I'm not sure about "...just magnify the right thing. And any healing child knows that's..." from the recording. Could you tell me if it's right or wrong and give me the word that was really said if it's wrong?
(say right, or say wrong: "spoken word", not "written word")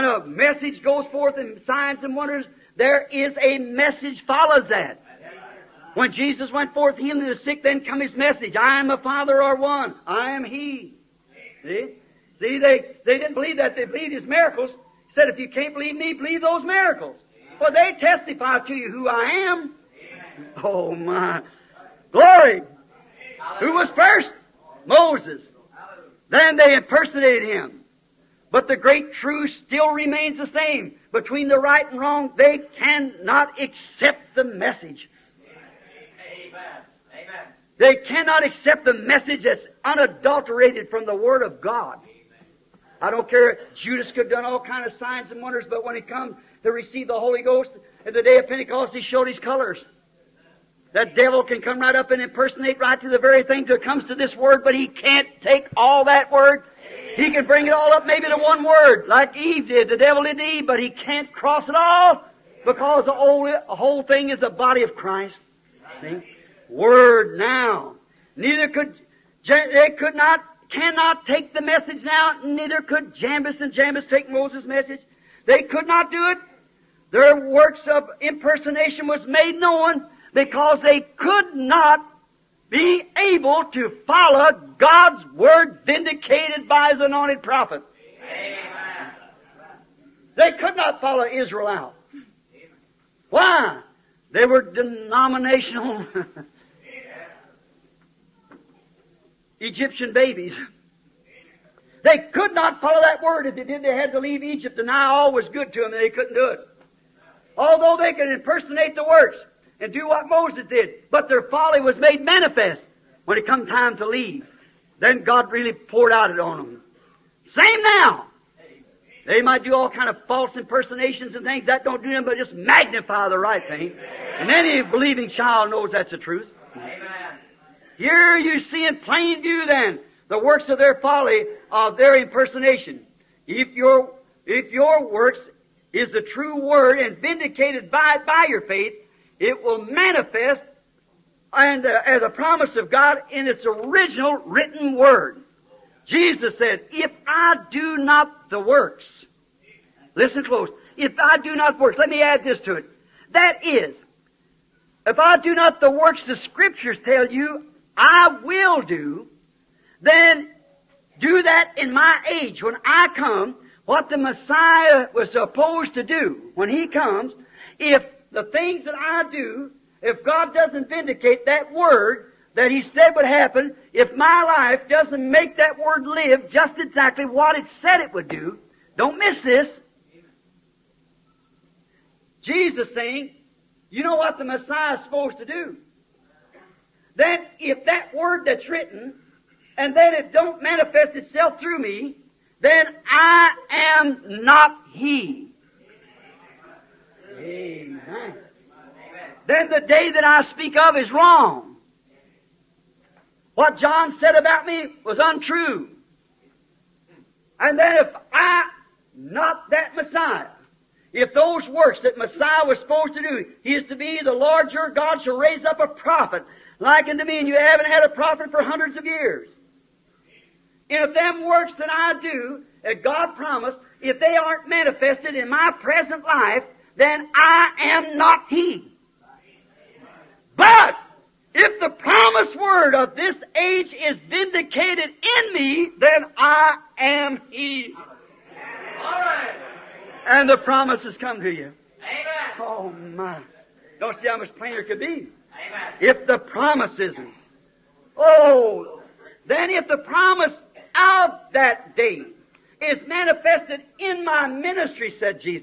wrong: "believing", not "healing".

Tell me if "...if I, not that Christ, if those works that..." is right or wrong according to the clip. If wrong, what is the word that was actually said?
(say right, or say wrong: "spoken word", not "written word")
wrong: "Messiah", not "Christ".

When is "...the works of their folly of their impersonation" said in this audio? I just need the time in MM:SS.
02:10.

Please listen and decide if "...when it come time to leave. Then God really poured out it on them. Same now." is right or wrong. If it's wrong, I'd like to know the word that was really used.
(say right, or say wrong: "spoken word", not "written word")
right.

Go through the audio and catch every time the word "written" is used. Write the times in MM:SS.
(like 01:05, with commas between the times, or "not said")
02:24, 03:08.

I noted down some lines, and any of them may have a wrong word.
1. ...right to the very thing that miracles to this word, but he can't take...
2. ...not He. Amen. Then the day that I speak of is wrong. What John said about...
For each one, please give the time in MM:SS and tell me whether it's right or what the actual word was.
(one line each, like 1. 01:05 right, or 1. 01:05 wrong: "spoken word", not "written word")
1. 00:52 wrong: "comes", not "miracles"
2. 03:14 right.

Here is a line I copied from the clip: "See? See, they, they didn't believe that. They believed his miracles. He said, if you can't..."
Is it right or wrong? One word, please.
right.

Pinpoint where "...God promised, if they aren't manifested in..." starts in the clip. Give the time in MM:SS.
03:43.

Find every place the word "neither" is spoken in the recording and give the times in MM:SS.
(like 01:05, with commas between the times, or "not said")
01:08, 01:12.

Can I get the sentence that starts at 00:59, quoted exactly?
The devil did Eve, but he can't cross it all because the whole, the whole thing is the body of Christ.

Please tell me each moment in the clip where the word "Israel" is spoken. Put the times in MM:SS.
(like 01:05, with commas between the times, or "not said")
01:31.